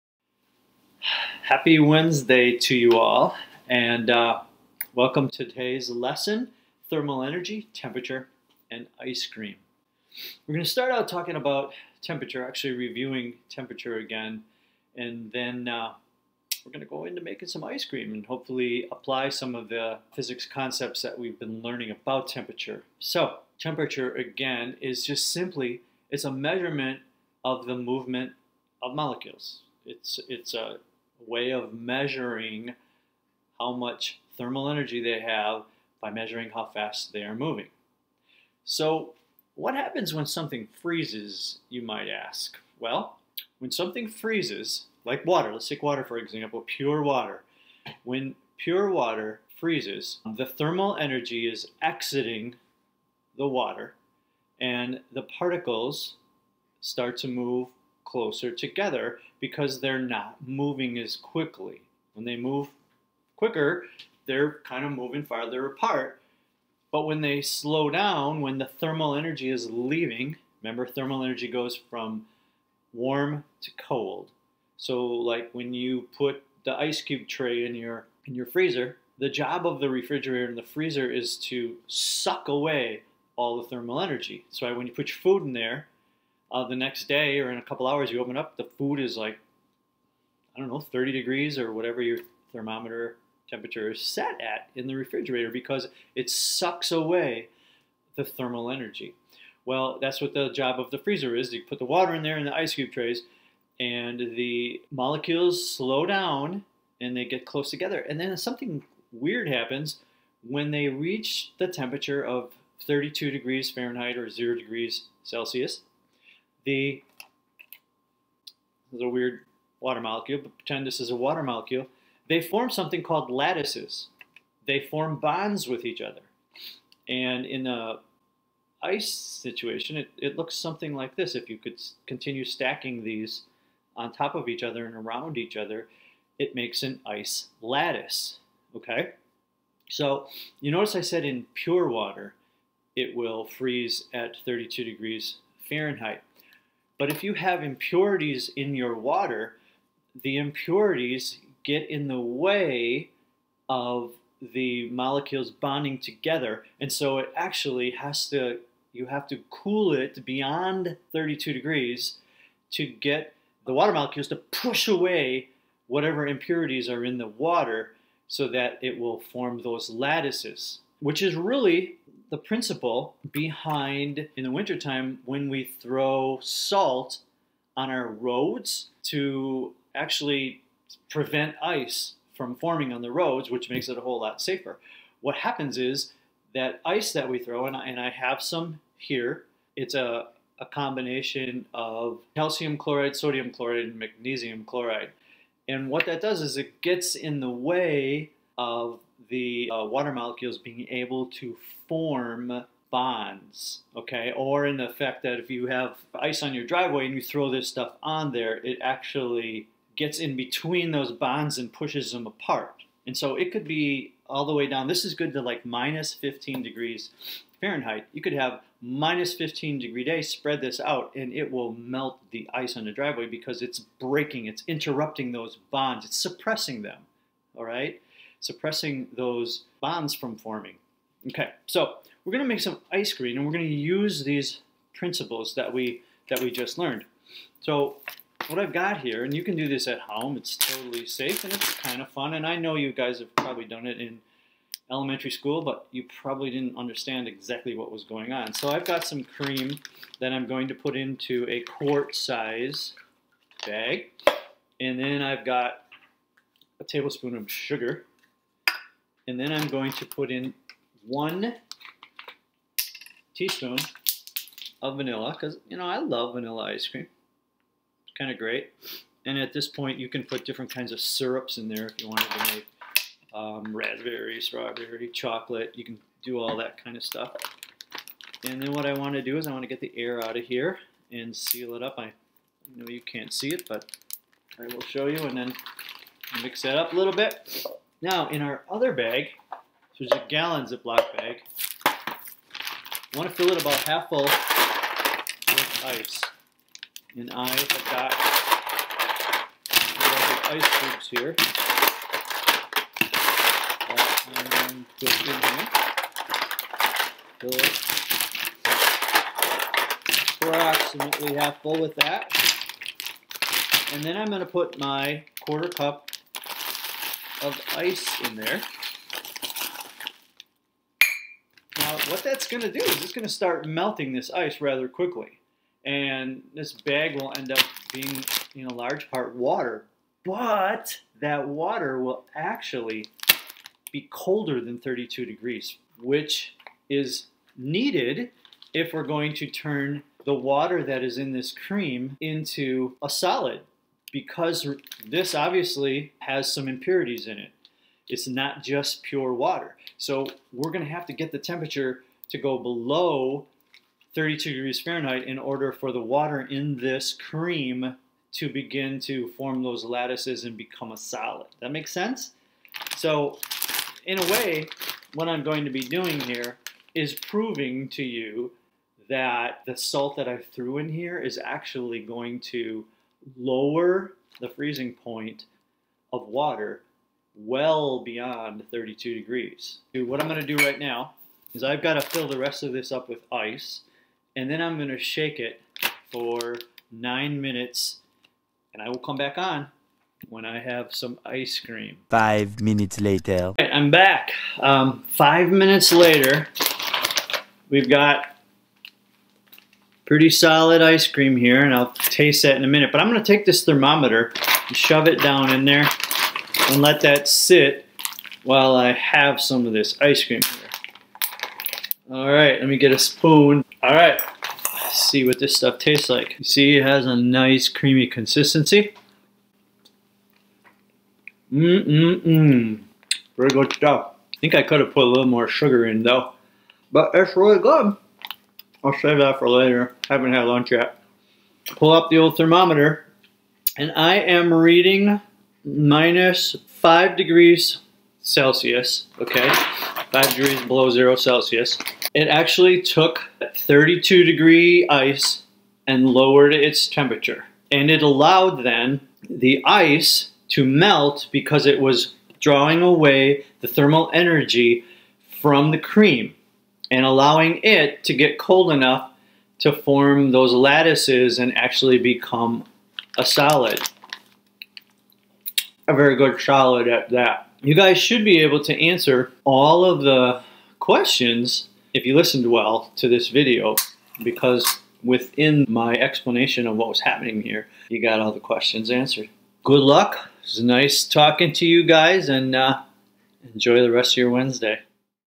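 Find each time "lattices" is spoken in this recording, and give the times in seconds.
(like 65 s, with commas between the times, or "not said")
123 s, 137 s, 169 s, 359 s, 460 s.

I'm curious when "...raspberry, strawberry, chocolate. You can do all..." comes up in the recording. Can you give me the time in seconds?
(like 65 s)
273 s.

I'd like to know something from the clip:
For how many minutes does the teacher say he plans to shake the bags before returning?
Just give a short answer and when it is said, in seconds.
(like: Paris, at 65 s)
9 minutes, at 386 s.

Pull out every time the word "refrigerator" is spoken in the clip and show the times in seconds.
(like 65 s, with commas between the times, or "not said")
79 s, 94 s.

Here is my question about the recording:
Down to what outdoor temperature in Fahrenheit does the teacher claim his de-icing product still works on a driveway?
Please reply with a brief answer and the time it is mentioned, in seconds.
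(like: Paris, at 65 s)
-15 degrees Fahrenheit, at 215 s.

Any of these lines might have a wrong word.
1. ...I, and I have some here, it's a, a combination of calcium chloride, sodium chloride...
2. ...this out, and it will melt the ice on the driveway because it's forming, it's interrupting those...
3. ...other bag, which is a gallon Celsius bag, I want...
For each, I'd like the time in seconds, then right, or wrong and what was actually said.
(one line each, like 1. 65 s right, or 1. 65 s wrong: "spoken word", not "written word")
1. 187 s right
2. 220 s wrong: "breaking", not "forming"
3. 288 s wrong: "Ziploc", not "Celsius".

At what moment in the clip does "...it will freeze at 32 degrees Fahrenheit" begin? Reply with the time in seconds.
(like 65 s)
142 s.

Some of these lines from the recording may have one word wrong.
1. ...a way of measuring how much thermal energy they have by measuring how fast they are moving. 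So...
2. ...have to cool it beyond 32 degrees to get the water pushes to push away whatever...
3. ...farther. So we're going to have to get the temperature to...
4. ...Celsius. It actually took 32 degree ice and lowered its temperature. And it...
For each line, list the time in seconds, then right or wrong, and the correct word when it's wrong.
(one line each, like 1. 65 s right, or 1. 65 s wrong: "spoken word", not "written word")
1. 30 s right
2. 159 s wrong: "molecules", not "pushes"
3. 349 s wrong: "water", not "farther"
4. 441 s right.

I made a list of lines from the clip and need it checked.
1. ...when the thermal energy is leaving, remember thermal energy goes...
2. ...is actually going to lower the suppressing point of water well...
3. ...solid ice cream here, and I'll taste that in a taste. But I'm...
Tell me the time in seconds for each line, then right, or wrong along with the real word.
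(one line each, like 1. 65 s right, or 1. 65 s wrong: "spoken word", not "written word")
1. 68 s right
2. 371 s wrong: "freezing", not "suppressing"
3. 400 s wrong: "minute", not "taste".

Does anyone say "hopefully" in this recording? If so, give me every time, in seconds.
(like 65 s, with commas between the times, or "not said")
18 s.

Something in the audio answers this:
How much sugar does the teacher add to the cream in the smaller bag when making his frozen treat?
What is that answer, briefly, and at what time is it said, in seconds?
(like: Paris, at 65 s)
a tablespoon, at 256 s.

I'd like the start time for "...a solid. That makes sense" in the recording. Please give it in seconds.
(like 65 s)
360 s.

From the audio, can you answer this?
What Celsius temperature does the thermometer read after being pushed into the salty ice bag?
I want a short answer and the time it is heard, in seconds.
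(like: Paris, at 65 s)
-5 degrees Celsius, at 435 s.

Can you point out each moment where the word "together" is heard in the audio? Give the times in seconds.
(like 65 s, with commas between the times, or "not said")
58 s, 107 s, 155 s.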